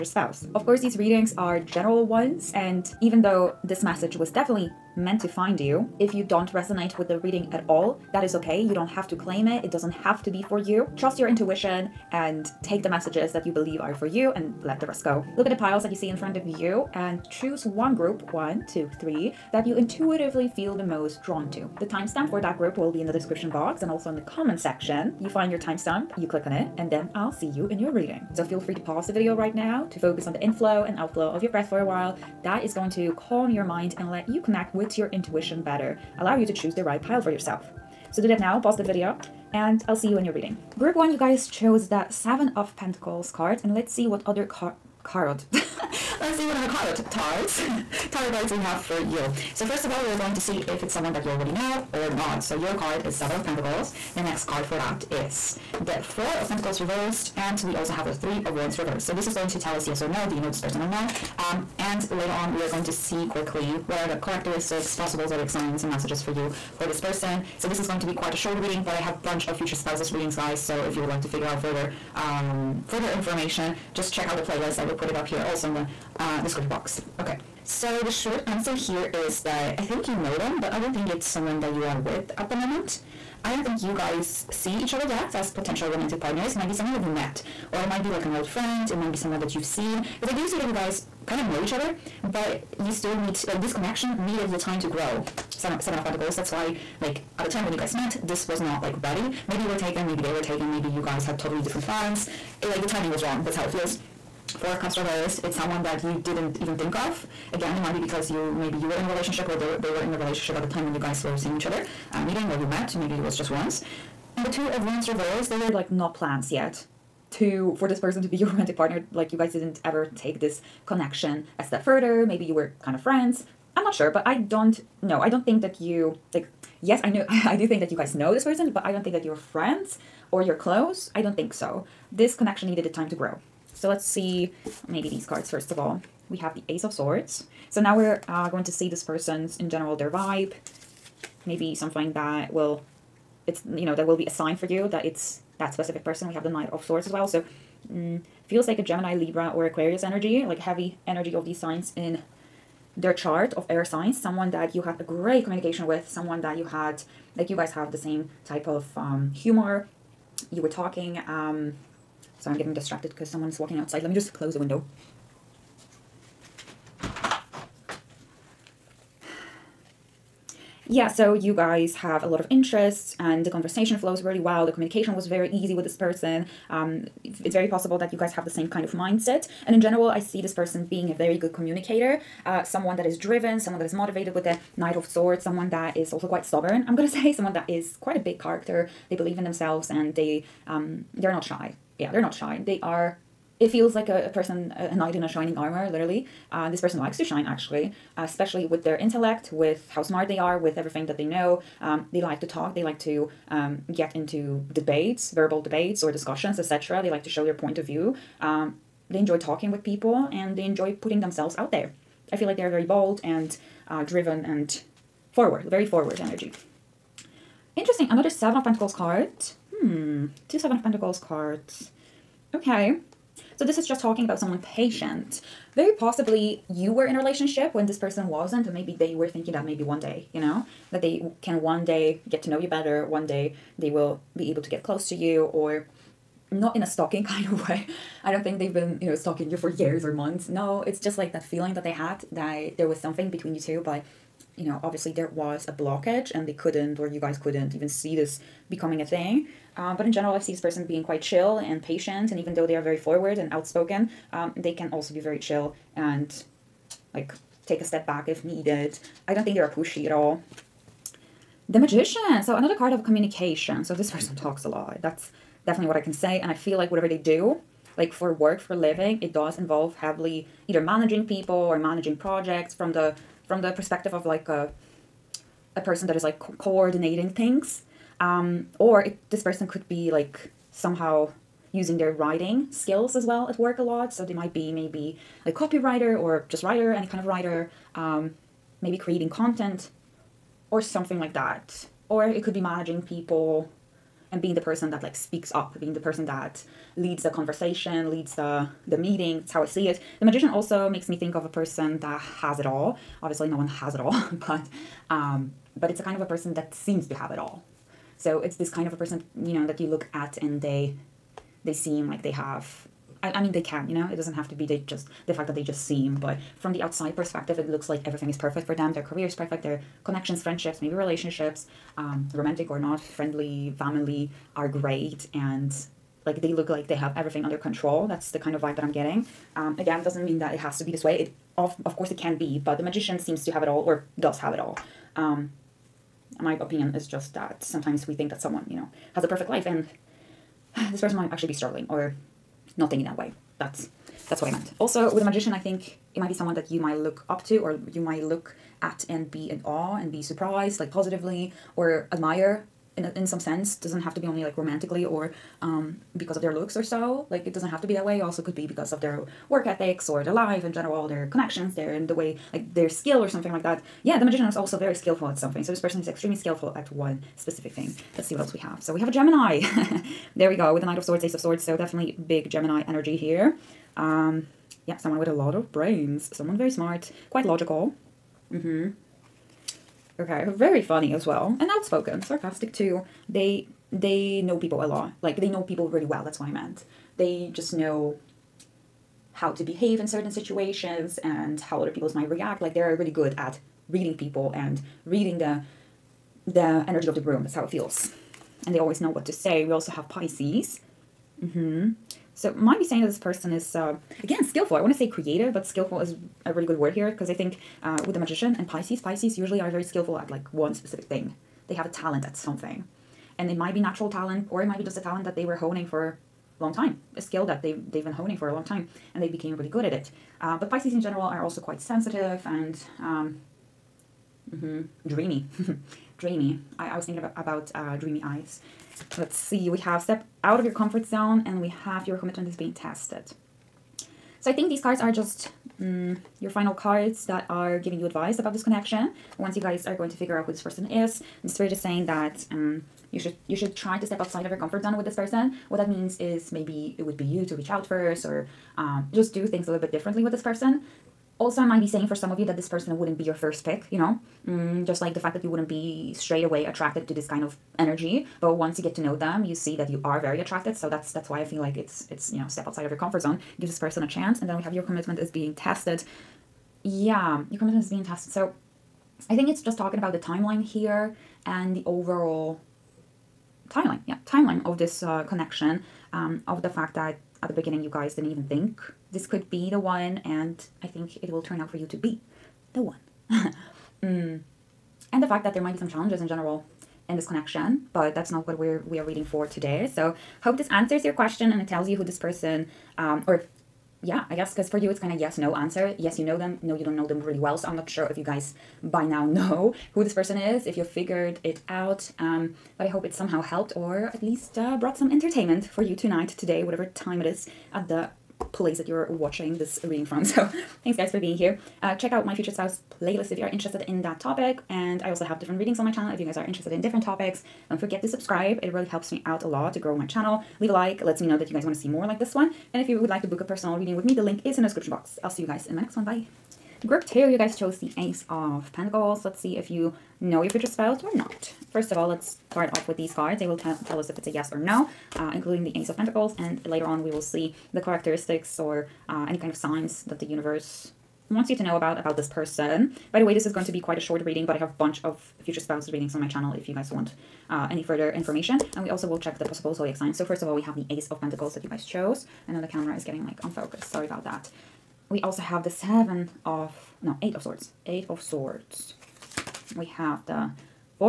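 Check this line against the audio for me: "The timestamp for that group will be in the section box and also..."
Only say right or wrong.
wrong.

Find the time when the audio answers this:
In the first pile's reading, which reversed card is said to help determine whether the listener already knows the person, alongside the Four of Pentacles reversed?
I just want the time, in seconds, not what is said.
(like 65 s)
58 s.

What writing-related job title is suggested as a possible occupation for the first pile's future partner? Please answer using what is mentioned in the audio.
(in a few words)
copywriter.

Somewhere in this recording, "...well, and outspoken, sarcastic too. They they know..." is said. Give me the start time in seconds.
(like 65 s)
381 s.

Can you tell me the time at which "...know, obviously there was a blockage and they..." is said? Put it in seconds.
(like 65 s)
244 s.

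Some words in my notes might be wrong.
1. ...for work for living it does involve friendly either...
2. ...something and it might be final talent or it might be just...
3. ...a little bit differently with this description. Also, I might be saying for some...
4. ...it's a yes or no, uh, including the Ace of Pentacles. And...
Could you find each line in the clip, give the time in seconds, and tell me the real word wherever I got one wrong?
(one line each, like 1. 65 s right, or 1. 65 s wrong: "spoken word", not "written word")
1. 268 s wrong: "heavily", not "friendly"
2. 412 s wrong: "natural", not "final"
3. 449 s wrong: "person", not "description"
4. 534 s right.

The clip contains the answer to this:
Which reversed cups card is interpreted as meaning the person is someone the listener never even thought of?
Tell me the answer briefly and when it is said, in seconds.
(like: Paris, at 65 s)
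Four of Cups, at 104 s.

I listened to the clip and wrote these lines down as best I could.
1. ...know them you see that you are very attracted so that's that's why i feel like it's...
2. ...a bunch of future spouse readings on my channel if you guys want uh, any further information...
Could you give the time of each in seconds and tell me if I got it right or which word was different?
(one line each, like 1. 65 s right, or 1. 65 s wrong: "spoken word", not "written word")
1. 458 s right
2. 544 s right.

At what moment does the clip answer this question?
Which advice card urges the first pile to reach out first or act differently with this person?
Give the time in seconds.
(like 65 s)
430 s.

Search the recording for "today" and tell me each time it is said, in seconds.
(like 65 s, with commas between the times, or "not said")
489 s, 506 s.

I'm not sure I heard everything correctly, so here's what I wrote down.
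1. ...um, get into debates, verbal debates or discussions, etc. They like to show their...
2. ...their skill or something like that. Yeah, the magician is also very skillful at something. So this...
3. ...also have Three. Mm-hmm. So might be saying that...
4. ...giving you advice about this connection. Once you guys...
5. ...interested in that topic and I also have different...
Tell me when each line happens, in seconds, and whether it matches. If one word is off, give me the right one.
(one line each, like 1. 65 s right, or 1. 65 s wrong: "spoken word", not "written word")
1. 203 s right
2. 362 s right
3. 399 s wrong: "Pisces", not "Three"
4. 437 s right
5. 513 s right.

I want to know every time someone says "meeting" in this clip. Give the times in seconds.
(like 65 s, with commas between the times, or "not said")
112 s, 298 s.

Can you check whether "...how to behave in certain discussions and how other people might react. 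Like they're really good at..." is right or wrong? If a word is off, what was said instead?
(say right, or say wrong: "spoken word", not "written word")
wrong: "situations", not "discussions".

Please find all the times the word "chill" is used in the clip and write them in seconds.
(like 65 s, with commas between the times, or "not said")
251 s, 255 s.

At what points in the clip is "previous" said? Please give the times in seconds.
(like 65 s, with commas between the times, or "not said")
not said.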